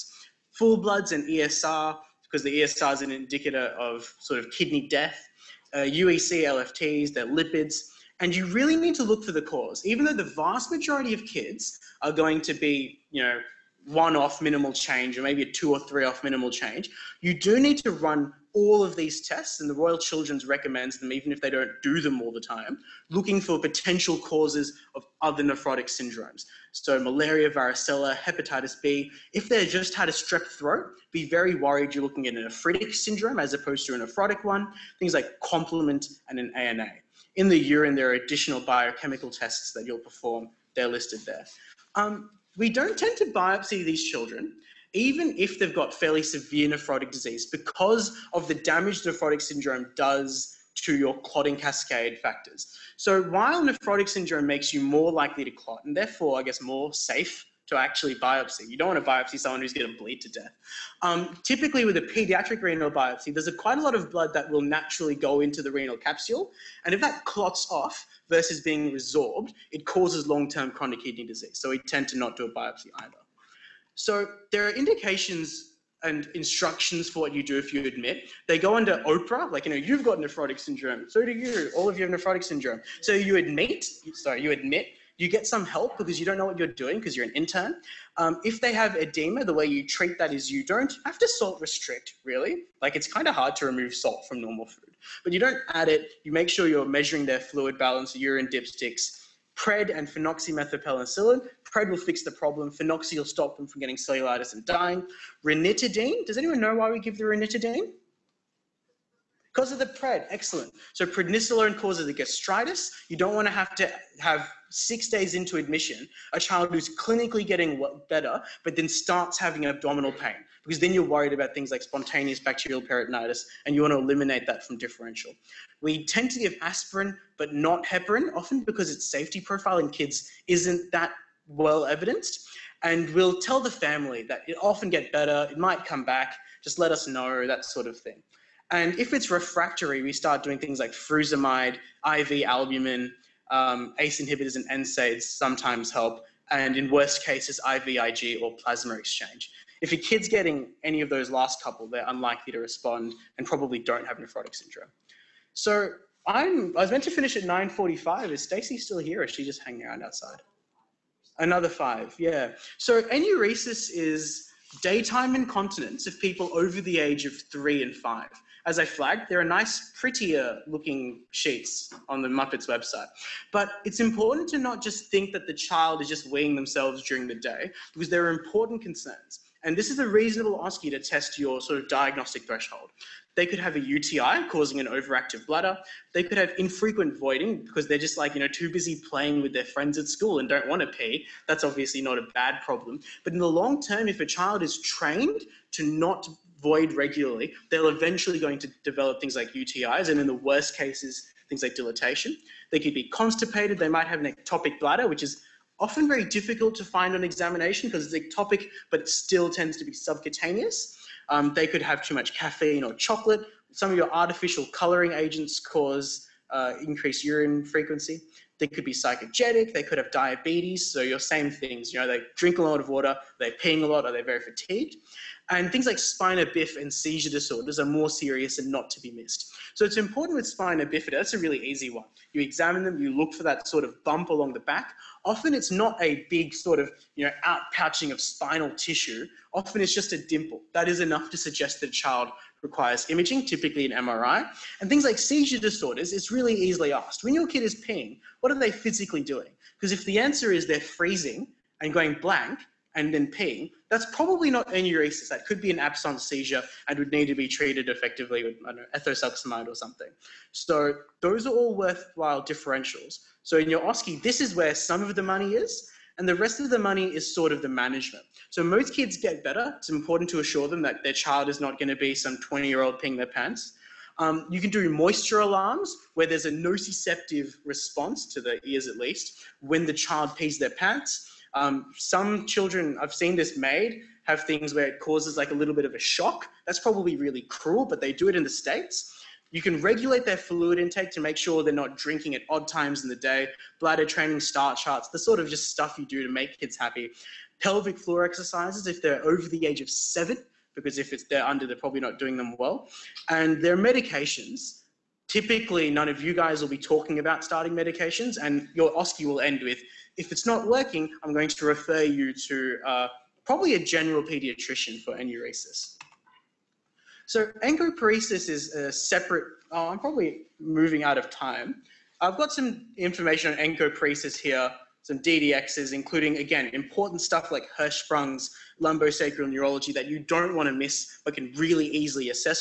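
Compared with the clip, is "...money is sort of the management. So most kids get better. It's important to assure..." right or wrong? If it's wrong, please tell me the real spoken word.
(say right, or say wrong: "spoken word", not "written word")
right.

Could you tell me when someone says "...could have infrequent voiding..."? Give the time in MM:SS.
03:06.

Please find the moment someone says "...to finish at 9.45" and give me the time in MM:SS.
02:37.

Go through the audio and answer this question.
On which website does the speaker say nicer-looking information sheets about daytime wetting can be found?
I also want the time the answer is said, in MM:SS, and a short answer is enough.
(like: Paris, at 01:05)
MUPPITS, at 02:52.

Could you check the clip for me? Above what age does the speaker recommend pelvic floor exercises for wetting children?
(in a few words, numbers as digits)
7.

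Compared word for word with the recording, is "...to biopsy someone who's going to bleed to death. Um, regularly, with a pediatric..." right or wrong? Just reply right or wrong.
wrong.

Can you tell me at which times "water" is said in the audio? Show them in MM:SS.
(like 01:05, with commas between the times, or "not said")
03:42.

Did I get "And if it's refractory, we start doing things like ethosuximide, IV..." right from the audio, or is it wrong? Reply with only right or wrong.
wrong.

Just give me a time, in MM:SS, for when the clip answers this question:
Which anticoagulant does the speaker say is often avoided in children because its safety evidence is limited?
02:07.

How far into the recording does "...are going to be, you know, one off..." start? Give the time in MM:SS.
00:12.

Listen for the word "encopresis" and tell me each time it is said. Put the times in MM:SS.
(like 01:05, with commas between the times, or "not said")
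05:17, 05:23.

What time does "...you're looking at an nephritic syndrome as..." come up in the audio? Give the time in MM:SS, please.
00:31.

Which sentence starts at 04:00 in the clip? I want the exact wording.
That is enough to suggest that a child requires imaging, typically an MRI.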